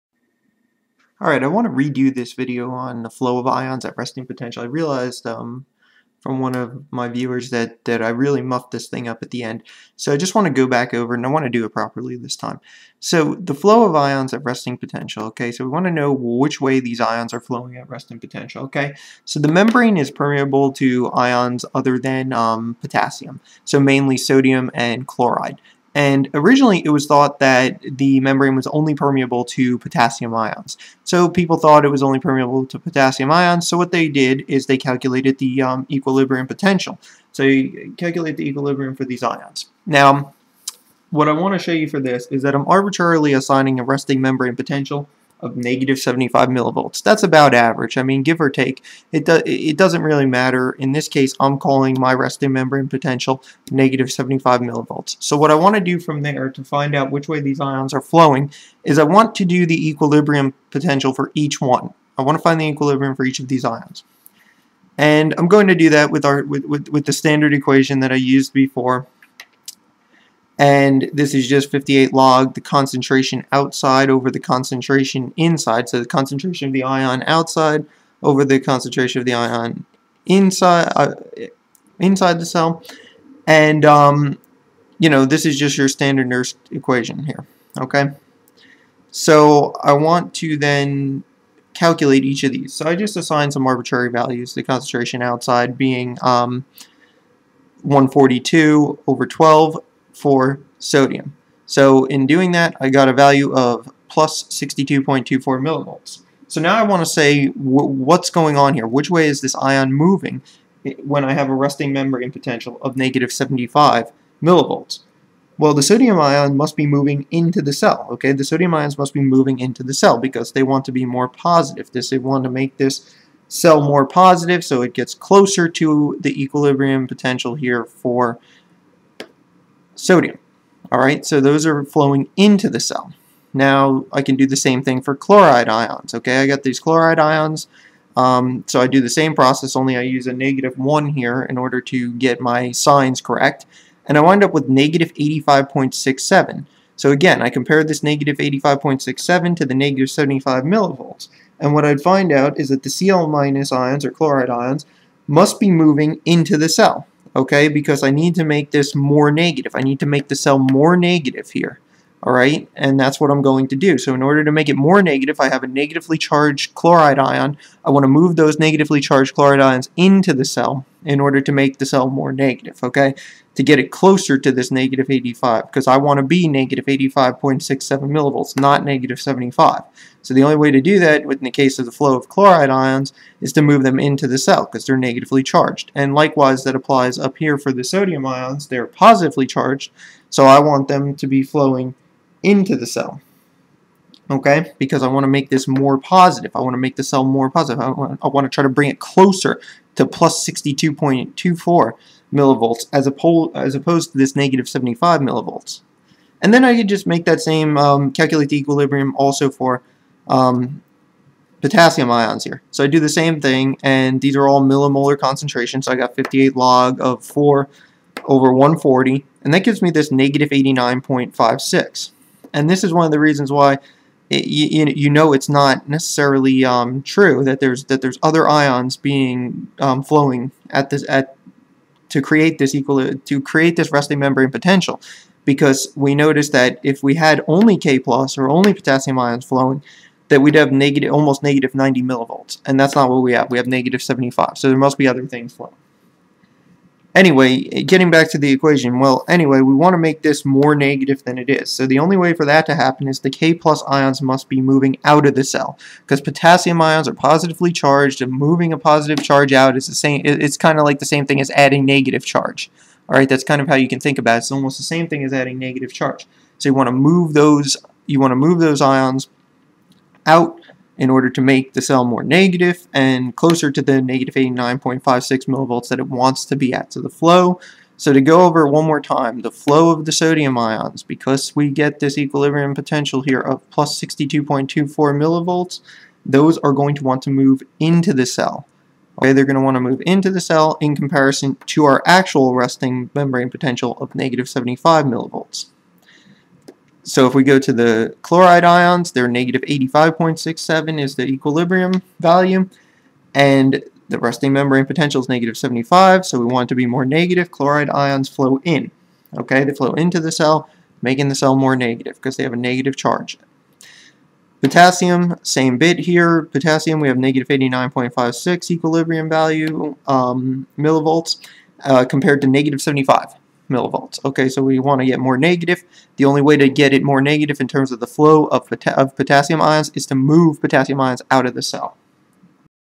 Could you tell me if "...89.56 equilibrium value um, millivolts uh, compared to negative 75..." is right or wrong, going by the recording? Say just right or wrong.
right.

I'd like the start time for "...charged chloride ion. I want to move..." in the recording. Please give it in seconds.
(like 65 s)
166 s.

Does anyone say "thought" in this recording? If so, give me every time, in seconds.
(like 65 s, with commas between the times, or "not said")
27 s, 31 s.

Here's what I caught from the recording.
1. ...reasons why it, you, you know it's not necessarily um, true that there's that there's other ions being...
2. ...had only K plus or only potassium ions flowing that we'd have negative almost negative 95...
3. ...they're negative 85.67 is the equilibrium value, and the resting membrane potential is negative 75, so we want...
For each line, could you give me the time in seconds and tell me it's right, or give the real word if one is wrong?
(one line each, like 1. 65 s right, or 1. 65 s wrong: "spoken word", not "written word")
1. 223 s right
2. 237 s wrong: "90", not "95"
3. 299 s right.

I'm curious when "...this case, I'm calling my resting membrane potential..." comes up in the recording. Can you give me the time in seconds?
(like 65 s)
50 s.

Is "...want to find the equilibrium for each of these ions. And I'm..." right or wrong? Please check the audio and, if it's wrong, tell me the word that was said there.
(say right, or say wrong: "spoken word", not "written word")
right.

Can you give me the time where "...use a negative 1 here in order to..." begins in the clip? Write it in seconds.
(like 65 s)
140 s.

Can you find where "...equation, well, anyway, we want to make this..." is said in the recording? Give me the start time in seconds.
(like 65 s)
248 s.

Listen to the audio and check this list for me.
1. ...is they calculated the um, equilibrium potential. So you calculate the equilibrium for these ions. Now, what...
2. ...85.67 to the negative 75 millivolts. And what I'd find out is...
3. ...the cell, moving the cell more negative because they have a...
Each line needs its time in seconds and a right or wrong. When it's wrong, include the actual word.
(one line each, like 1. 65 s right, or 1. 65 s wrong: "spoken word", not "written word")
1. 34 s right
2. 148 s right
3. 310 s wrong: "making", not "moving".